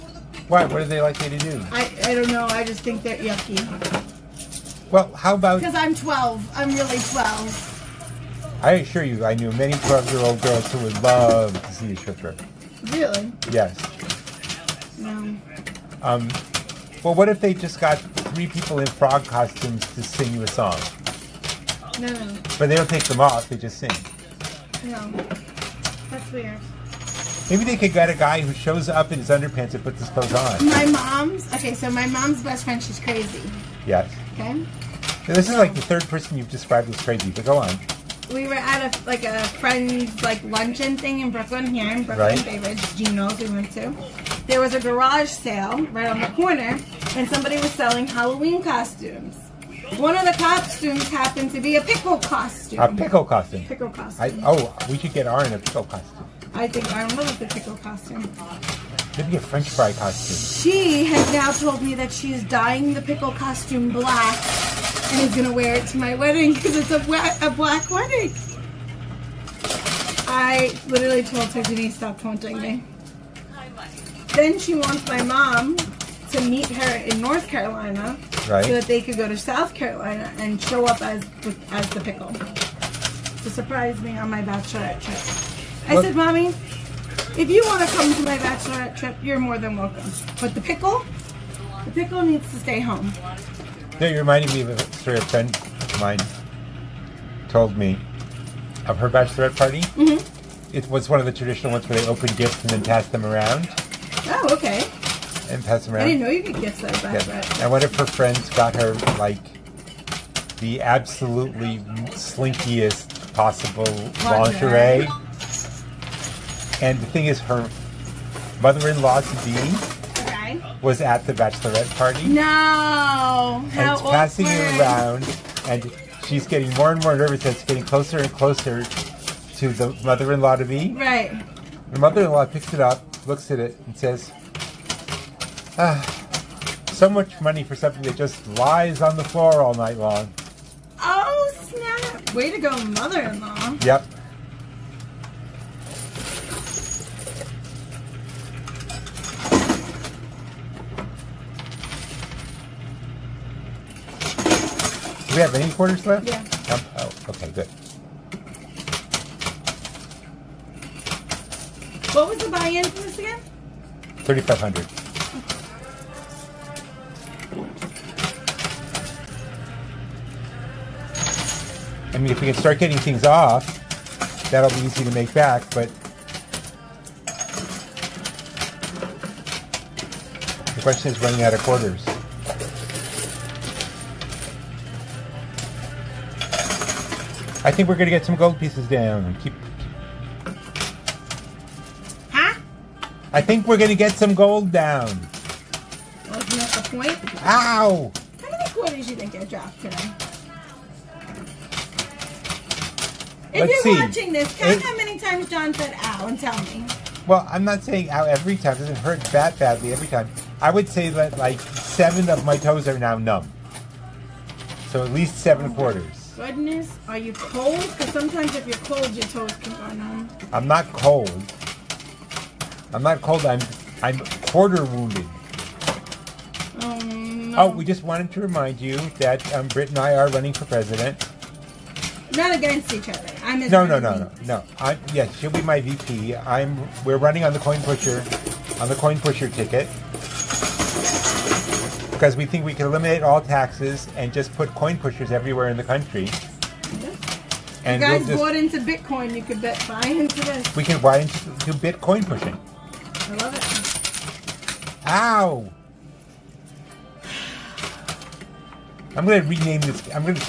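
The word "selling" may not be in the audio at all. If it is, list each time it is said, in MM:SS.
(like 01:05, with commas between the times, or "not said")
00:47.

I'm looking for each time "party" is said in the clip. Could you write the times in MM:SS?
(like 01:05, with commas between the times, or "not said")
01:39, 02:01.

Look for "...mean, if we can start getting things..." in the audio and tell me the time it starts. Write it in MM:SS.
02:52.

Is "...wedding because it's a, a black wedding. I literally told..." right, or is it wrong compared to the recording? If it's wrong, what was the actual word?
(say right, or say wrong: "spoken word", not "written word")
right.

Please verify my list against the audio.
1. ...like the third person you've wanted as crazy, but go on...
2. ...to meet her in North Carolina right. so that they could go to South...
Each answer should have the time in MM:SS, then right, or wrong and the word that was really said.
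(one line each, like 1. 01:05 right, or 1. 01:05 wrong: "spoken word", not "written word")
1. 00:35 wrong: "described", not "wanted"
2. 01:16 right.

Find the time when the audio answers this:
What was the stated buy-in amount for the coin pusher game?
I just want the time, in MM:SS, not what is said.
02:44.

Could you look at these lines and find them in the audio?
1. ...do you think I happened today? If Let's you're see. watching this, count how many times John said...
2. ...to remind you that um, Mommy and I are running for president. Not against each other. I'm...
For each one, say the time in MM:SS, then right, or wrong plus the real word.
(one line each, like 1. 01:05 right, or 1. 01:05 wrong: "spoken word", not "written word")
1. 03:19 wrong: "dropped", not "happened"
2. 03:48 wrong: "Britt", not "Mommy".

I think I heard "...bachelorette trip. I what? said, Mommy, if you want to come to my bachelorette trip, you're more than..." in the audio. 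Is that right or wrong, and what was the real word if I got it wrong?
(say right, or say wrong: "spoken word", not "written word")
right.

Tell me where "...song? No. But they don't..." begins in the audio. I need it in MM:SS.
00:20.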